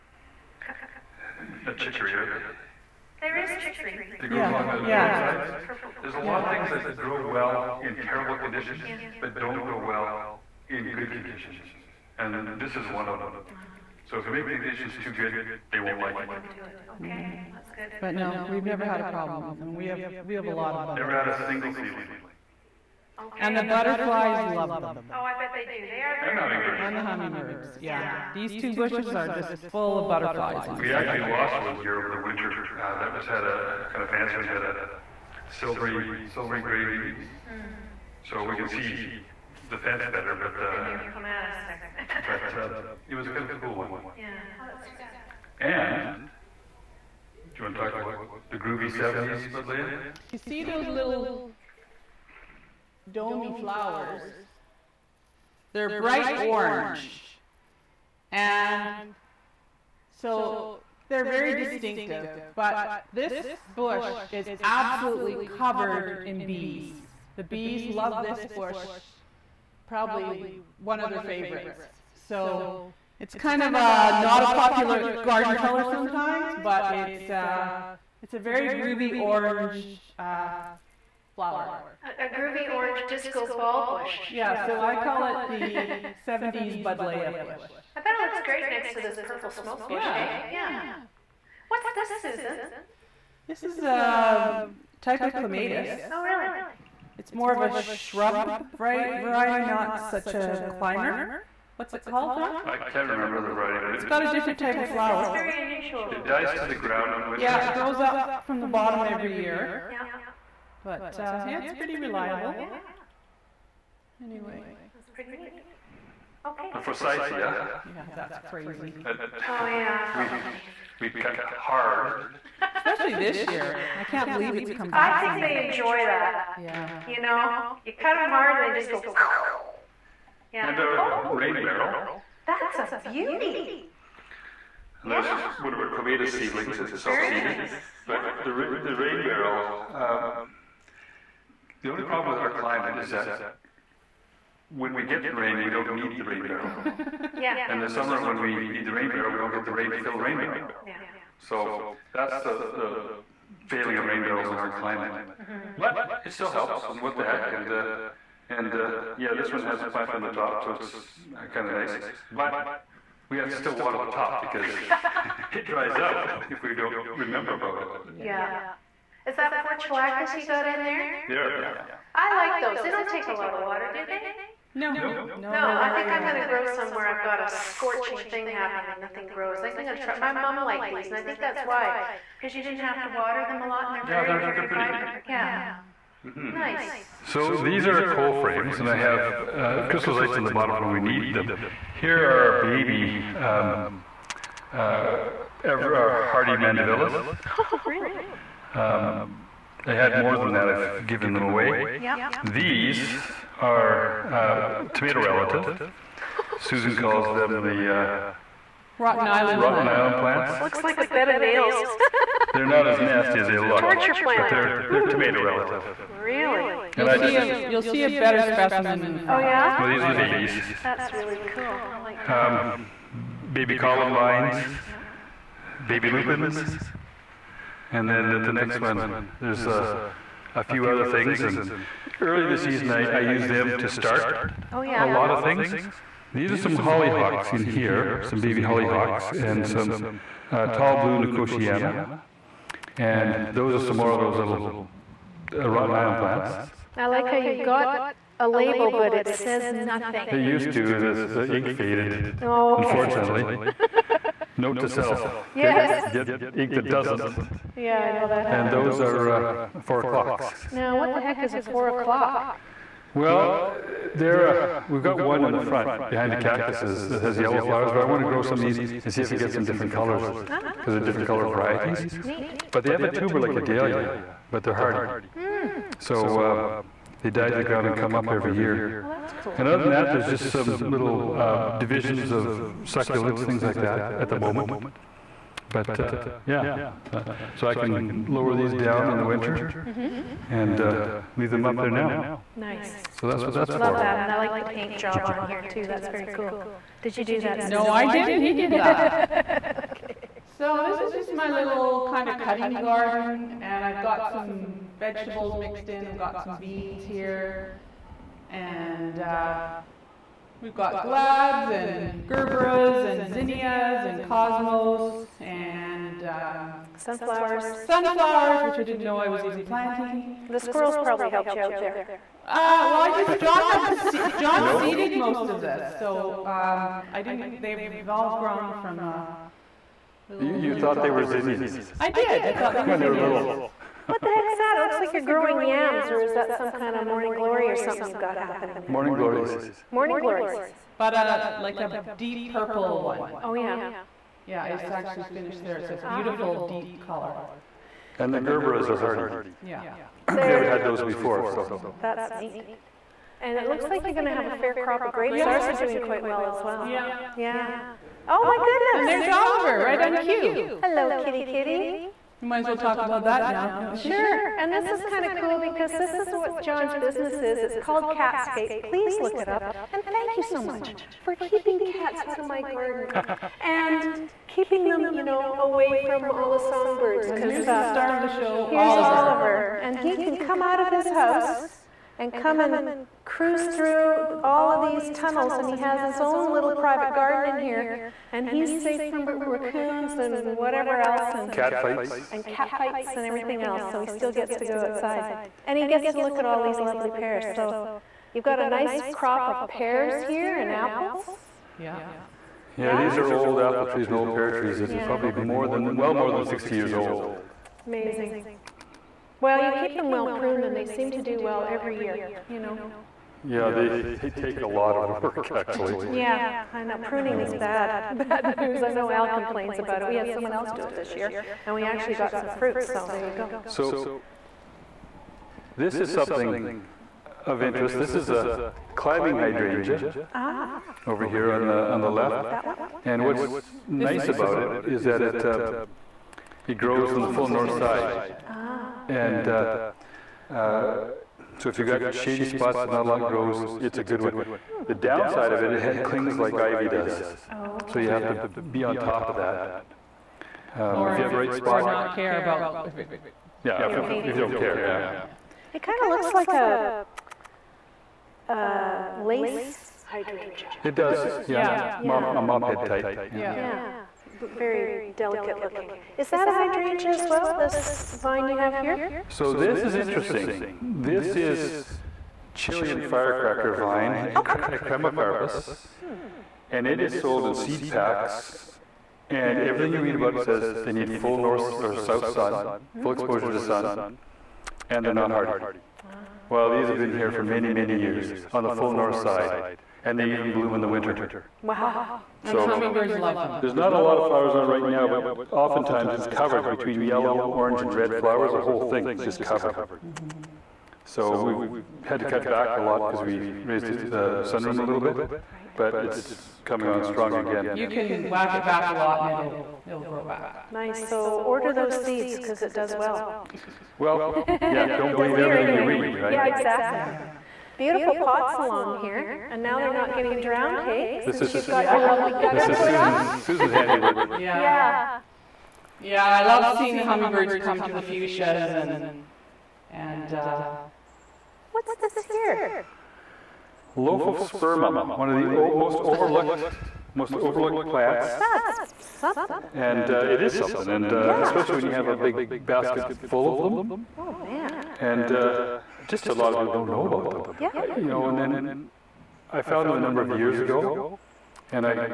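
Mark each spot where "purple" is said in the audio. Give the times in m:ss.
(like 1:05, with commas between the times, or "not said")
0:05, 1:29, 5:42.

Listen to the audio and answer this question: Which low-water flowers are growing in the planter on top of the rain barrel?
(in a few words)
portulacas.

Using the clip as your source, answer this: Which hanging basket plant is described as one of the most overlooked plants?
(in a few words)
Lophospermum.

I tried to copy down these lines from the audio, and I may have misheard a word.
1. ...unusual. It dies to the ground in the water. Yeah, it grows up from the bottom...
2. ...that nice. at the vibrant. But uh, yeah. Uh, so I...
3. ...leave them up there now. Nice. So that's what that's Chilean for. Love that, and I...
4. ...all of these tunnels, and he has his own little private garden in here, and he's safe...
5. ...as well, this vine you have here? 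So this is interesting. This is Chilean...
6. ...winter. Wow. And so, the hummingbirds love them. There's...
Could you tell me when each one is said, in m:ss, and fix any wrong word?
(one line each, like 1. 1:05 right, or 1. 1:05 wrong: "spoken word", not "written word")
1. 1:45 wrong: "winter", not "water"
2. 4:43 wrong: "moment", not "vibrant"
3. 4:51 wrong: "Love", not "Chilean"
4. 6:24 right
5. 7:47 right
6. 8:10 right.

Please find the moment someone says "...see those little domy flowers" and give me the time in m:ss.
0:50.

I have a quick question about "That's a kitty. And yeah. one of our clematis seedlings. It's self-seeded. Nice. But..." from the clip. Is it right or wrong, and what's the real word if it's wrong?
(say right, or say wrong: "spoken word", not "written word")
wrong: "beauty", not "kitty".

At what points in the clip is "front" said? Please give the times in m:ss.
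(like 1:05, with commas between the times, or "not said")
3:39, 4:25.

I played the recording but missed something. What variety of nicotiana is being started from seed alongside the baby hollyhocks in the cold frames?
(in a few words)
tall blue nicotiana.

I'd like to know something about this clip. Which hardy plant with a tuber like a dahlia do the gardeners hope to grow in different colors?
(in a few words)
4 o'clocks.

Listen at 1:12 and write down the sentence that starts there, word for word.
So it's kind of a, uh, not a popular garden color sometimes, but it's, uh, it's a very groovy orange uh, flower.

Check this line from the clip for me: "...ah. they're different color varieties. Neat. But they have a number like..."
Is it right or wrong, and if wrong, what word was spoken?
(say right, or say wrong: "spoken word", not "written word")
wrong: "tuber", not "number".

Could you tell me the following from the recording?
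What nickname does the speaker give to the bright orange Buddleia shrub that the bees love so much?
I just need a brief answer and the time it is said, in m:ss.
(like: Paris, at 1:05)
70s Buddleia bush, at 1:26.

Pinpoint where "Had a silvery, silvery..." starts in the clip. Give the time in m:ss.
0:34.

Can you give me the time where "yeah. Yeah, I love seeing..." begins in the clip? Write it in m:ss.
8:44.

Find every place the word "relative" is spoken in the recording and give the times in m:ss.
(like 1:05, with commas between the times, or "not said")
3:25, 3:35.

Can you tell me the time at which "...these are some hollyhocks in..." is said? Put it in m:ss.
3:56.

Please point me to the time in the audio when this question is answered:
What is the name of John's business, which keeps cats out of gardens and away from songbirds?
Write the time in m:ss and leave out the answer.
6:08.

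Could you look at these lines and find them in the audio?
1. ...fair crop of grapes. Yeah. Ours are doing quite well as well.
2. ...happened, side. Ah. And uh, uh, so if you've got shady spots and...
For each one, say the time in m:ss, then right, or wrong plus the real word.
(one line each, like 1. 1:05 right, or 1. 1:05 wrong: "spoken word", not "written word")
1. 5:54 right
2. 7:17 wrong: "finished", not "happened".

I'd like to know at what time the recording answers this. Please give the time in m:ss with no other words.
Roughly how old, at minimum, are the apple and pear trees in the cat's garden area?
6:46.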